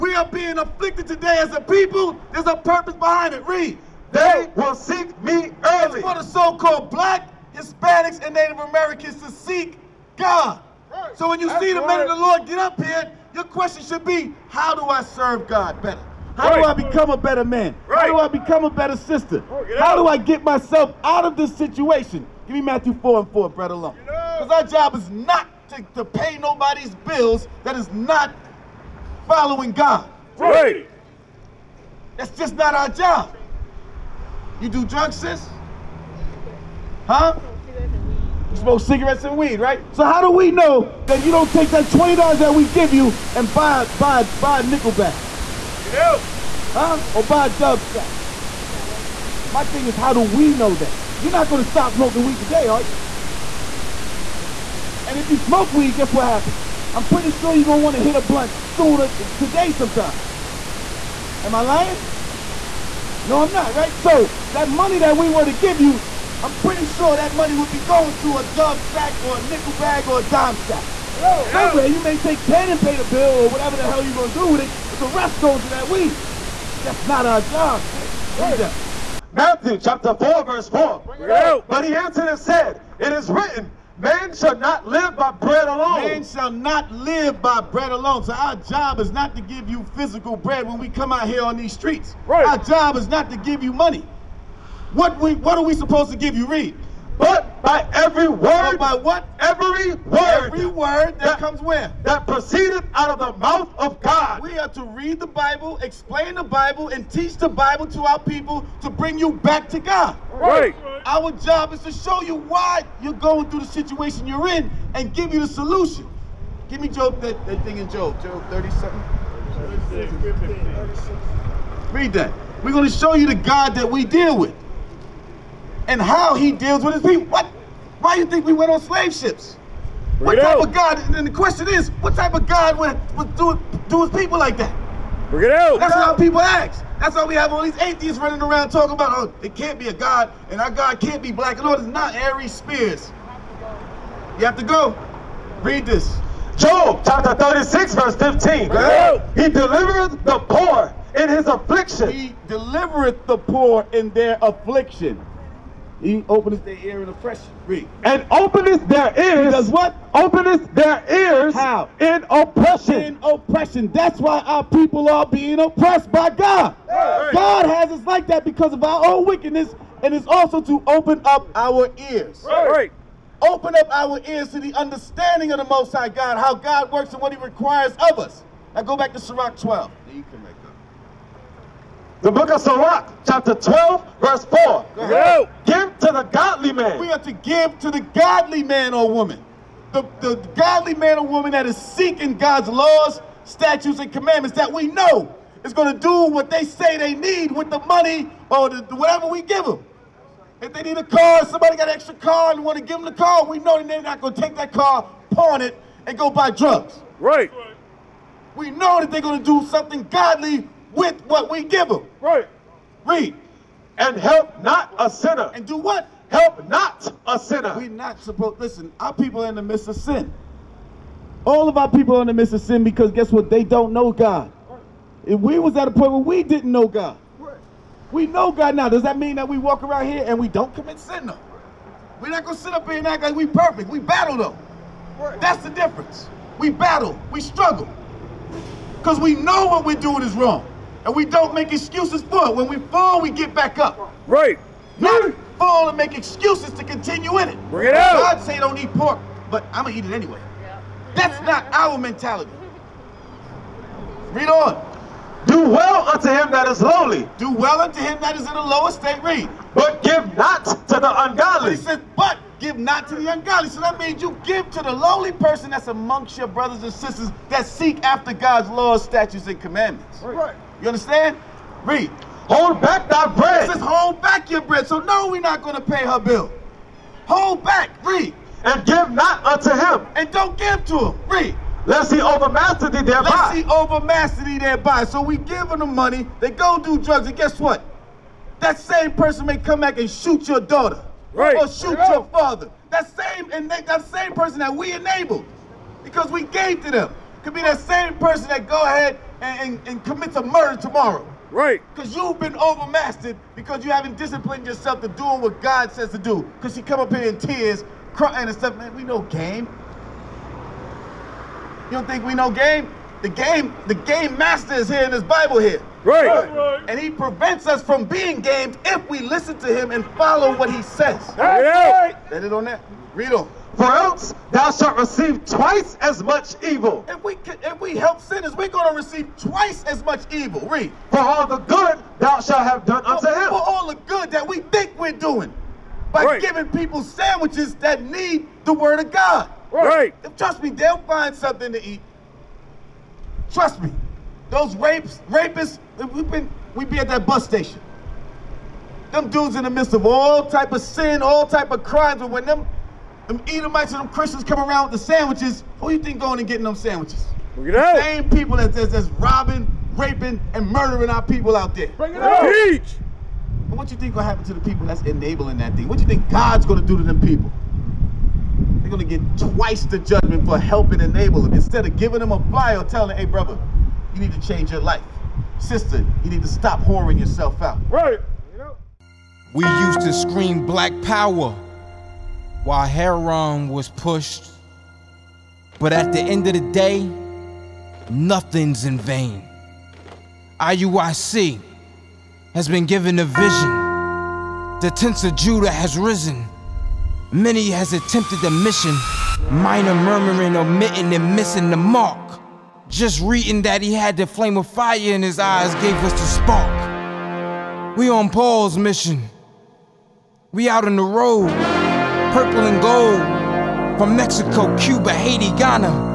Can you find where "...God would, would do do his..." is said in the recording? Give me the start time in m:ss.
2:12.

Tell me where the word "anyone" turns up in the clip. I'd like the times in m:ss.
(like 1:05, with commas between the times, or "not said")
not said.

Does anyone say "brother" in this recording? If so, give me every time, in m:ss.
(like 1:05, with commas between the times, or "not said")
0:23, 4:26, 6:13.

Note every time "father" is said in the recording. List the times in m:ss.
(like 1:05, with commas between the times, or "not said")
4:52.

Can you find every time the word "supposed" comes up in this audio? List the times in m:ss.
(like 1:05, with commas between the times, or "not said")
1:35, 3:38.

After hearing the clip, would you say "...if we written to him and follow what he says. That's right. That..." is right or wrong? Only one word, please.
wrong.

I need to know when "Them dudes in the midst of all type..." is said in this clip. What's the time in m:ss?
5:49.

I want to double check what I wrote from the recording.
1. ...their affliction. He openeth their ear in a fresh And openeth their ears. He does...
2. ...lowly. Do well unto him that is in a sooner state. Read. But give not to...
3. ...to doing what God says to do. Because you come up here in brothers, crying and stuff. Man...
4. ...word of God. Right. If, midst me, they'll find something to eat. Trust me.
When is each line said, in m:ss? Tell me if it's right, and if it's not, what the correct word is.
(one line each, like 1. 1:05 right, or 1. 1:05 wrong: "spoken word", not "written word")
1. 2:34 right
2. 4:16 wrong: "lower", not "sooner"
3. 5:05 wrong: "tears", not "brothers"
4. 5:38 wrong: "trust", not "midst".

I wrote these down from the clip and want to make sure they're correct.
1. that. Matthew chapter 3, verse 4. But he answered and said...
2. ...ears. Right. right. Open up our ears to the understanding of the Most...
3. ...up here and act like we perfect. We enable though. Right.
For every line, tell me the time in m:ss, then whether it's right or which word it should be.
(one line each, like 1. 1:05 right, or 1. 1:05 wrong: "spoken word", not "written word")
1. 1:18 wrong: "4", not "3"
2. 2:52 right
3. 3:52 wrong: "battle", not "enable".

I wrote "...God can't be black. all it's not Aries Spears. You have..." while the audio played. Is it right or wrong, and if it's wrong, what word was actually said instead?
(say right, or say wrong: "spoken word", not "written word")
right.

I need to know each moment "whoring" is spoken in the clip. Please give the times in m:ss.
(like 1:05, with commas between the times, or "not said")
6:16.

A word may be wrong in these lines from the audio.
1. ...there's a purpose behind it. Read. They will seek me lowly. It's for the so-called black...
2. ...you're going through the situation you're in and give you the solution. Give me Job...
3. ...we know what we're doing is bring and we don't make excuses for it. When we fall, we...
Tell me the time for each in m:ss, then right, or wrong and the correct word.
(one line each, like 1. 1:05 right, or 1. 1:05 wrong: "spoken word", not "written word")
1. 0:02 wrong: "early", not "lowly"
2. 1:53 right
3. 3:59 wrong: "wrong", not "bring".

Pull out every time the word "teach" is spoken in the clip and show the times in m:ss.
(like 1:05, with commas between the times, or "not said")
1:47, 6:02.